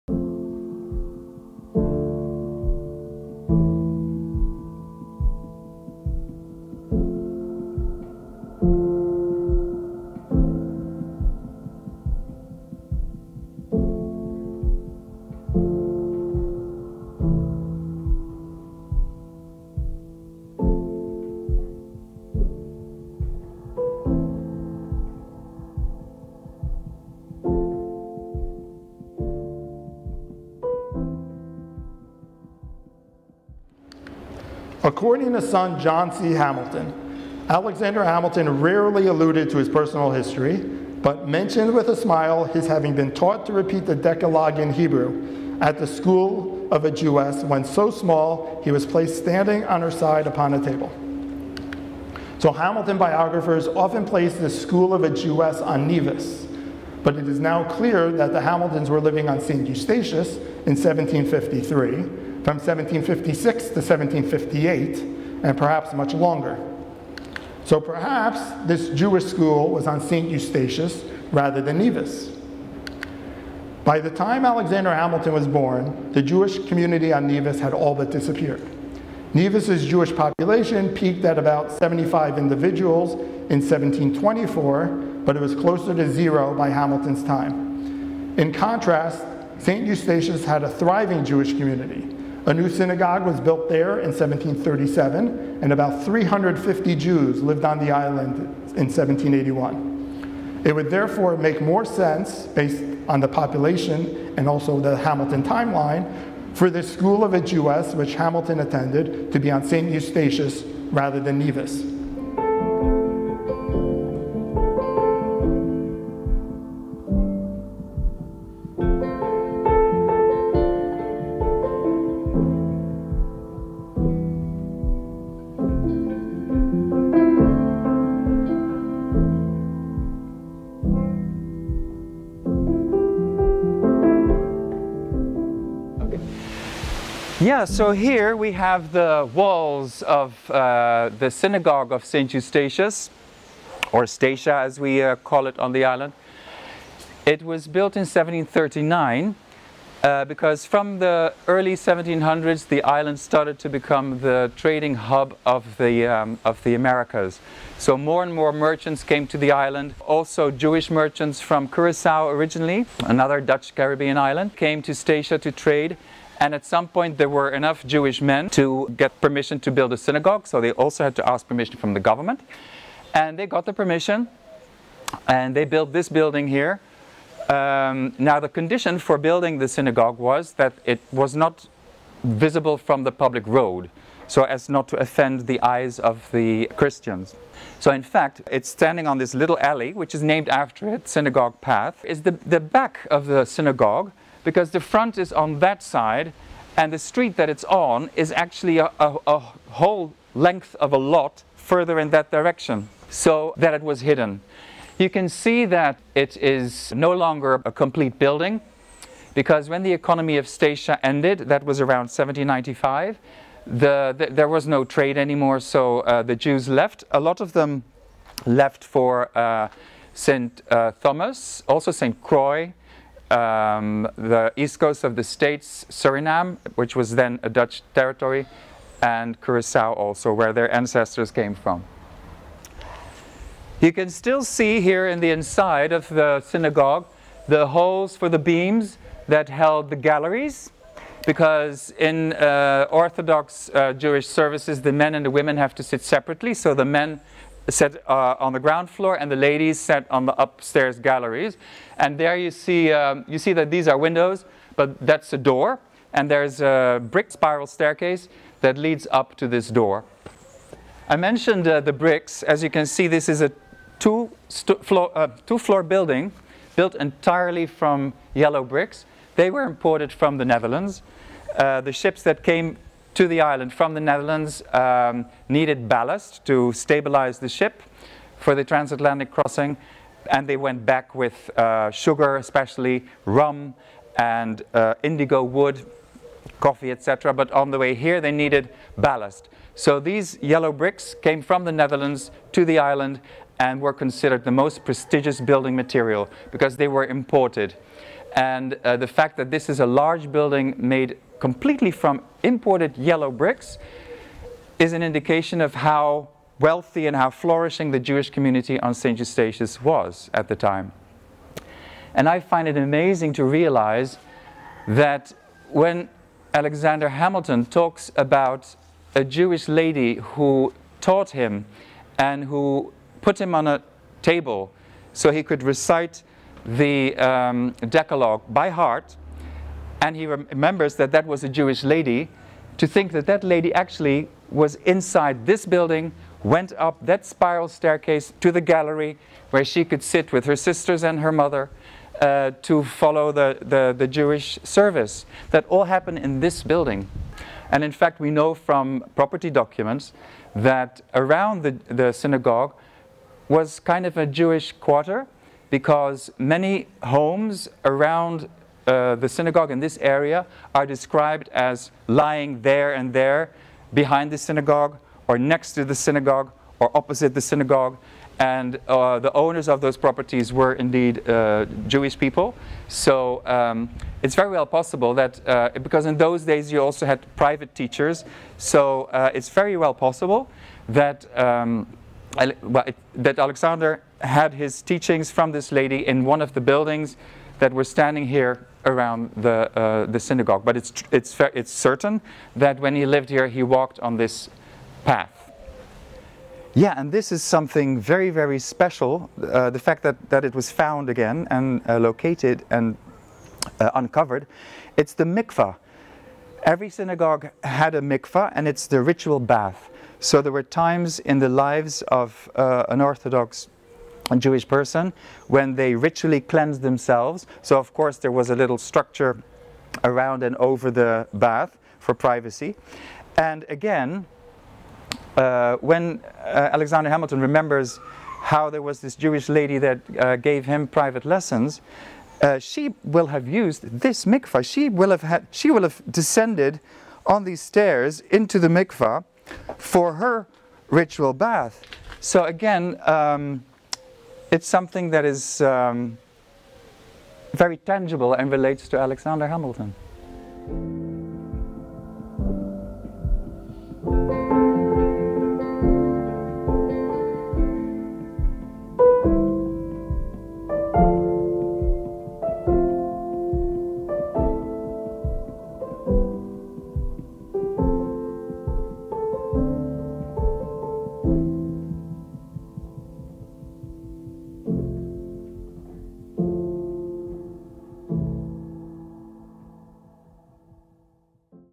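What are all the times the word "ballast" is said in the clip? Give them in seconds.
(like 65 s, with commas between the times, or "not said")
275 s, 288 s.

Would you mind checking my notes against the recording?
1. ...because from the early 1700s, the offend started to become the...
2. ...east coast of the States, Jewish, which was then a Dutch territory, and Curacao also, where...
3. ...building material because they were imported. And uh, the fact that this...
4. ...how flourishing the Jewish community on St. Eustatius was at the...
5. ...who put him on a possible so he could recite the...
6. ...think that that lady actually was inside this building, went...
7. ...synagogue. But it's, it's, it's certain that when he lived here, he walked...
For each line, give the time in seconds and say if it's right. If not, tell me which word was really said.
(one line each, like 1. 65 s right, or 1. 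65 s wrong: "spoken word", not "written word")
1. 150 s wrong: "island", not "offend"
2. 224 s wrong: "Suriname", not "Jewish"
3. 295 s right
4. 307 s right
5. 322 s wrong: "table", not "possible"
6. 332 s right
7. 390 s right.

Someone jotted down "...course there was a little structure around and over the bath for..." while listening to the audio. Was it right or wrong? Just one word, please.
right.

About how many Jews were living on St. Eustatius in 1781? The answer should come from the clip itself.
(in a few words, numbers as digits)
350.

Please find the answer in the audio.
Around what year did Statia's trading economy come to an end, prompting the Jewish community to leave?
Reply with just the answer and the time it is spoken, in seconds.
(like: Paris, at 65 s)
1795, at 212 s.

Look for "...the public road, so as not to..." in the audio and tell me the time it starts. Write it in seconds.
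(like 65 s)
183 s.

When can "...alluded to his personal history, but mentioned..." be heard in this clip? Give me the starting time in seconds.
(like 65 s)
39 s.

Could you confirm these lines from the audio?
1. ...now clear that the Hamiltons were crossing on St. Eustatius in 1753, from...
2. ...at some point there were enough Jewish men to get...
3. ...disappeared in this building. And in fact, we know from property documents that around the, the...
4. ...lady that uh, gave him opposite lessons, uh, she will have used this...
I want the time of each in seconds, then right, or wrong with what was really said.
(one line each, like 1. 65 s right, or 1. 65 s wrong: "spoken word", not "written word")
1. 57 s wrong: "living", not "crossing"
2. 166 s right
3. 345 s wrong: "happened", not "disappeared"
4. 429 s wrong: "private", not "opposite".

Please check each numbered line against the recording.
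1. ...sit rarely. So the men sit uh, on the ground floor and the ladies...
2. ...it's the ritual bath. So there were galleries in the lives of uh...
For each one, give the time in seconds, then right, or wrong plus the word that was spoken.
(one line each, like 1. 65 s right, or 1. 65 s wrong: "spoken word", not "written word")
1. 245 s wrong: "separately", not "rarely"
2. 408 s wrong: "times", not "galleries".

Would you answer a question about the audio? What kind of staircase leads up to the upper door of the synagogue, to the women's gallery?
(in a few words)
brick spiral staircase.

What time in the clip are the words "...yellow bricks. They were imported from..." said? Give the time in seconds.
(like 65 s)
268 s.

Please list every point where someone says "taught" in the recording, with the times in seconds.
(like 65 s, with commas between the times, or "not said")
43 s, 320 s.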